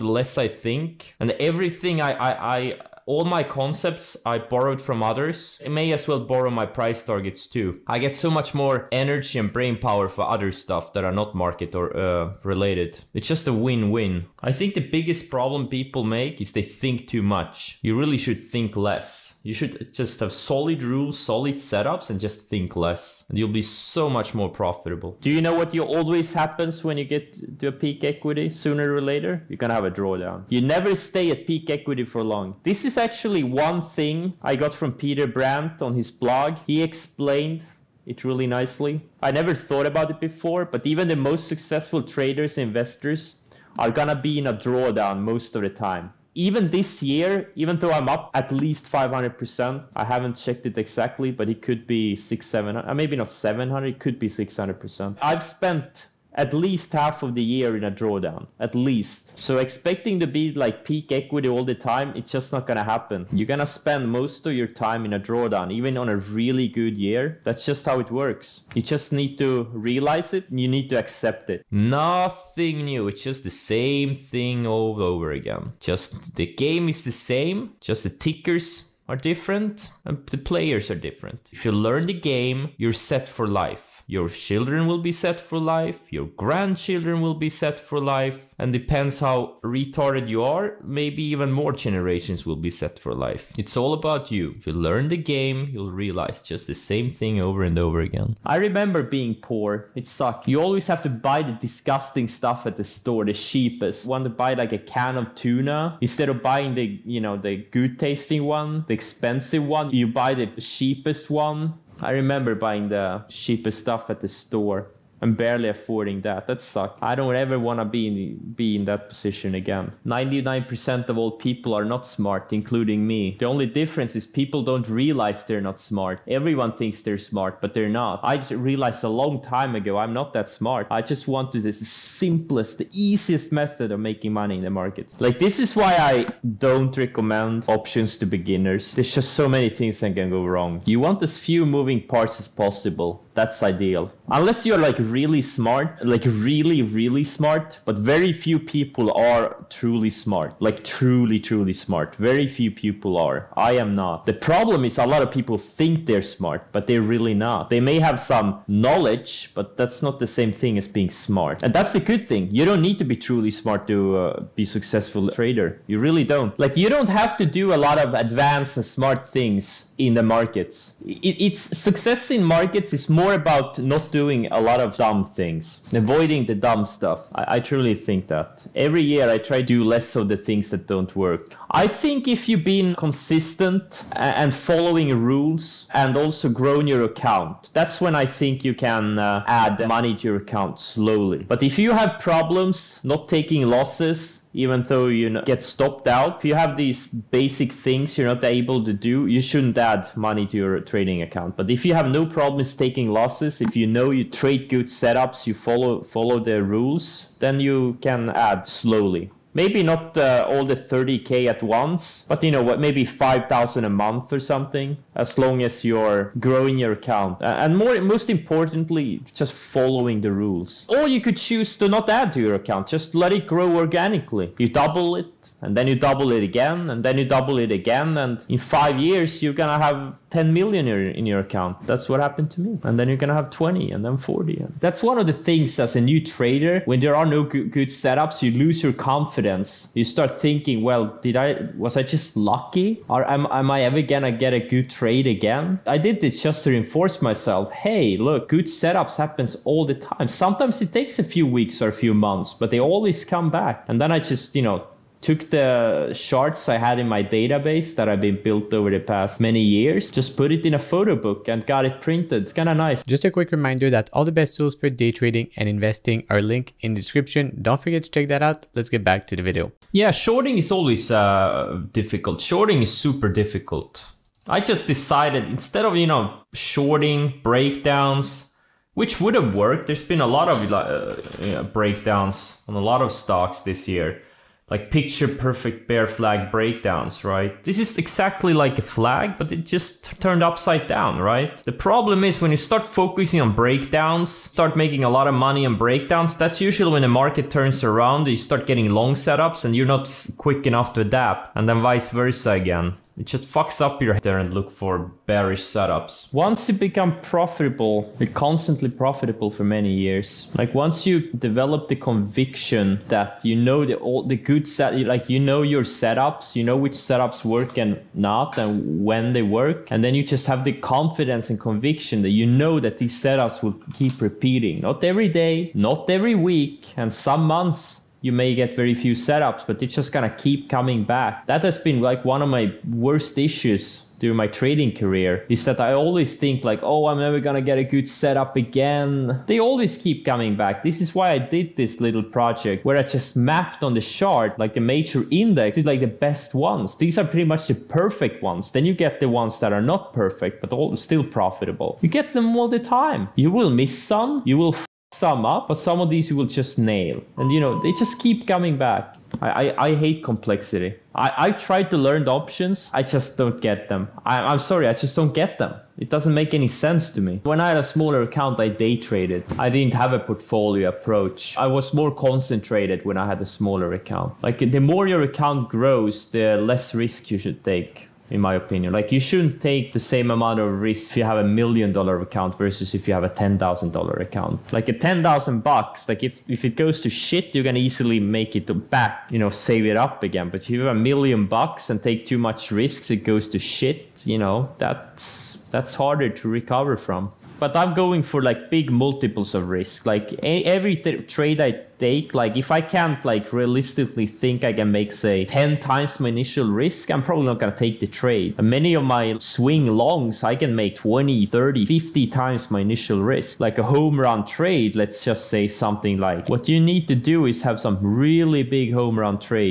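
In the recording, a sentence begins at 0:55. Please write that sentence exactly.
I've spent at least half of the year in a drawdown, at least.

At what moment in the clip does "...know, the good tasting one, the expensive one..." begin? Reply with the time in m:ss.
1:47.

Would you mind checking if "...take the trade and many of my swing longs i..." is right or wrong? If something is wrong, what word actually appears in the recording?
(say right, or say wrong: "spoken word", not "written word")
right.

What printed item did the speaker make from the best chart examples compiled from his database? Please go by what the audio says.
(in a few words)
a photo book.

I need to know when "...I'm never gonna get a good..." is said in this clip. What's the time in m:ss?
5:37.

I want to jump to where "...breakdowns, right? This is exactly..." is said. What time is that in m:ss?
4:46.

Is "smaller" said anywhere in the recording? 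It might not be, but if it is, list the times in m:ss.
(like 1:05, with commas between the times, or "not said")
6:07, 6:13.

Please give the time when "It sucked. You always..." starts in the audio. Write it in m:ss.
1:39.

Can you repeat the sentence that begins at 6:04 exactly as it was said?
I, I'm sorry, I just don't get them.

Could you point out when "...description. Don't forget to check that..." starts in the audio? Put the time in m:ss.
4:26.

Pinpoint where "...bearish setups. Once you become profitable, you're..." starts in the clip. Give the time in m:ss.
5:05.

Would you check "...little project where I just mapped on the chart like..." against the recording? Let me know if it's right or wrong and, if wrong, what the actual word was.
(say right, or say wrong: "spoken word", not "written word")
right.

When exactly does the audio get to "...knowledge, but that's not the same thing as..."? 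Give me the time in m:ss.
2:38.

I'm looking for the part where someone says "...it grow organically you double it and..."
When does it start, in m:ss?
3:43.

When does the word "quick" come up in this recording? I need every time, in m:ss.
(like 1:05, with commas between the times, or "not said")
4:23, 5:00.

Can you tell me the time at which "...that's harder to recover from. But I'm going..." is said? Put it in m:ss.
6:35.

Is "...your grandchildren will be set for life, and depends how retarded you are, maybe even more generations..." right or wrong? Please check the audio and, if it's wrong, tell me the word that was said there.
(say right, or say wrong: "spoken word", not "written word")
right.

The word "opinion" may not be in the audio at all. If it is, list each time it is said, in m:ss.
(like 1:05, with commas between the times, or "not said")
6:18.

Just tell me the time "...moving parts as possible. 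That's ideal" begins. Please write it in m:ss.
2:21.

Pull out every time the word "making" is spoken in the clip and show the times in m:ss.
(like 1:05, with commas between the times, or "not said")
2:13, 4:54.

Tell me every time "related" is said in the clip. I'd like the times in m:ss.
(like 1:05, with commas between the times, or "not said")
0:12.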